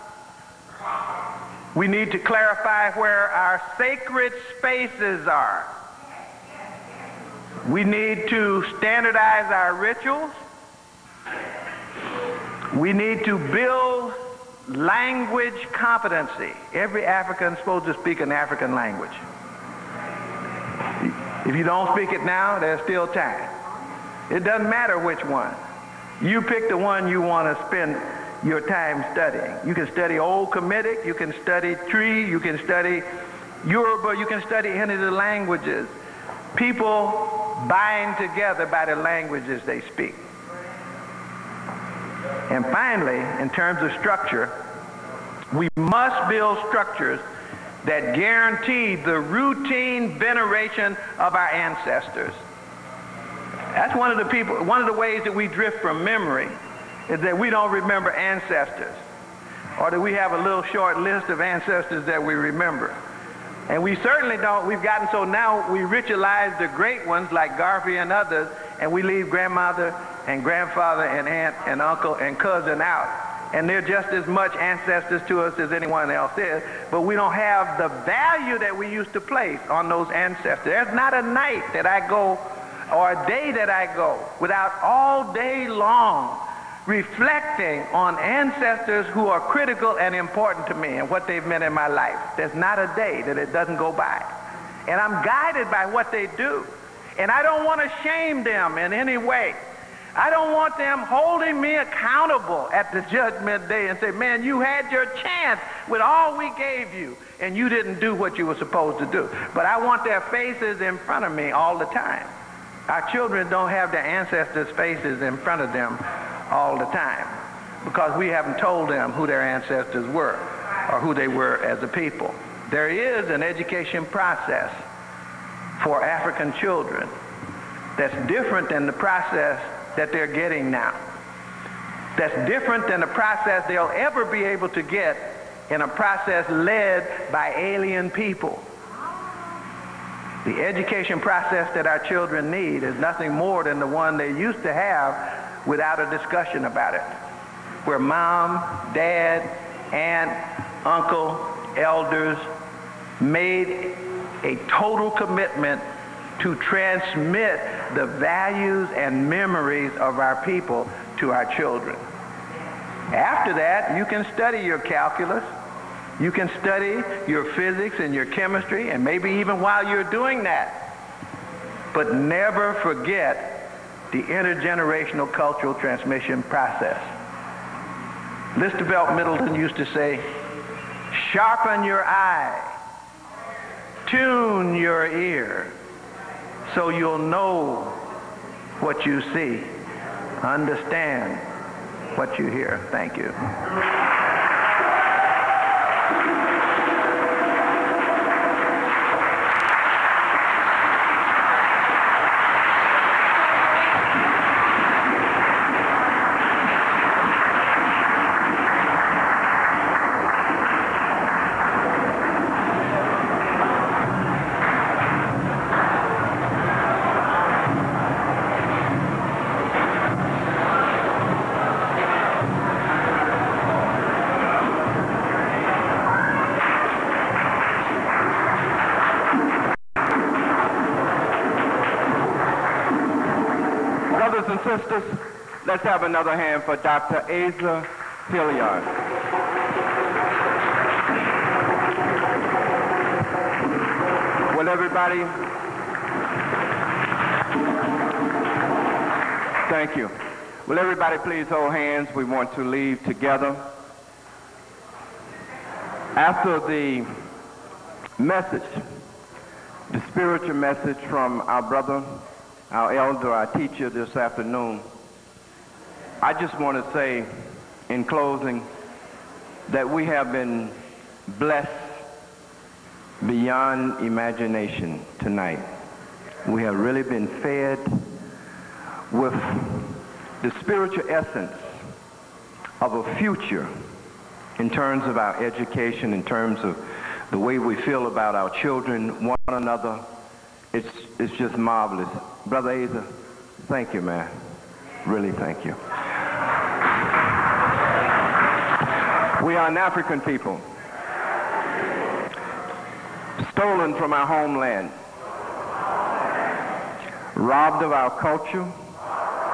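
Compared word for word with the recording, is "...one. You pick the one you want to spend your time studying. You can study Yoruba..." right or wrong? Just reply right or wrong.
wrong.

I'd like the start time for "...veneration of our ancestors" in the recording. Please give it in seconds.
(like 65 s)
50 s.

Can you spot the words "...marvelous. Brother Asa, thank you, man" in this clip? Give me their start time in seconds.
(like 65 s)
291 s.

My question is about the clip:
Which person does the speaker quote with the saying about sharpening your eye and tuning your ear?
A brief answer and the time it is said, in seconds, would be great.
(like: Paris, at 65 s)
Listervelt Middleton, at 178 s.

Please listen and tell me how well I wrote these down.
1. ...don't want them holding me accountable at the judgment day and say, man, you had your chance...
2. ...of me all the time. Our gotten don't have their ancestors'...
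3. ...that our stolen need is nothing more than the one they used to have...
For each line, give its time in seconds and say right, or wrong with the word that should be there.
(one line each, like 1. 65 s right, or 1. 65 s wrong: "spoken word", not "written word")
1. 100 s right
2. 111 s wrong: "children", not "gotten"
3. 141 s wrong: "children", not "stolen".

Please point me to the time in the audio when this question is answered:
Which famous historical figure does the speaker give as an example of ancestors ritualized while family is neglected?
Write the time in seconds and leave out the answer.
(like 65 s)
67 s.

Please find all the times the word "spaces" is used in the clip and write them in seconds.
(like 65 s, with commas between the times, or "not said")
4 s.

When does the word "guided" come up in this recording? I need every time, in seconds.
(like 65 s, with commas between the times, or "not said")
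95 s.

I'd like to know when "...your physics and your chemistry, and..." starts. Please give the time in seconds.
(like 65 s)
167 s.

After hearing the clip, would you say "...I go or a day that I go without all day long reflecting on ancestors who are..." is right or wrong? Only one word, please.
right.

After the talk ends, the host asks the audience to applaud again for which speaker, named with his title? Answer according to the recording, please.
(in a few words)
Dr. Asa Hilliard.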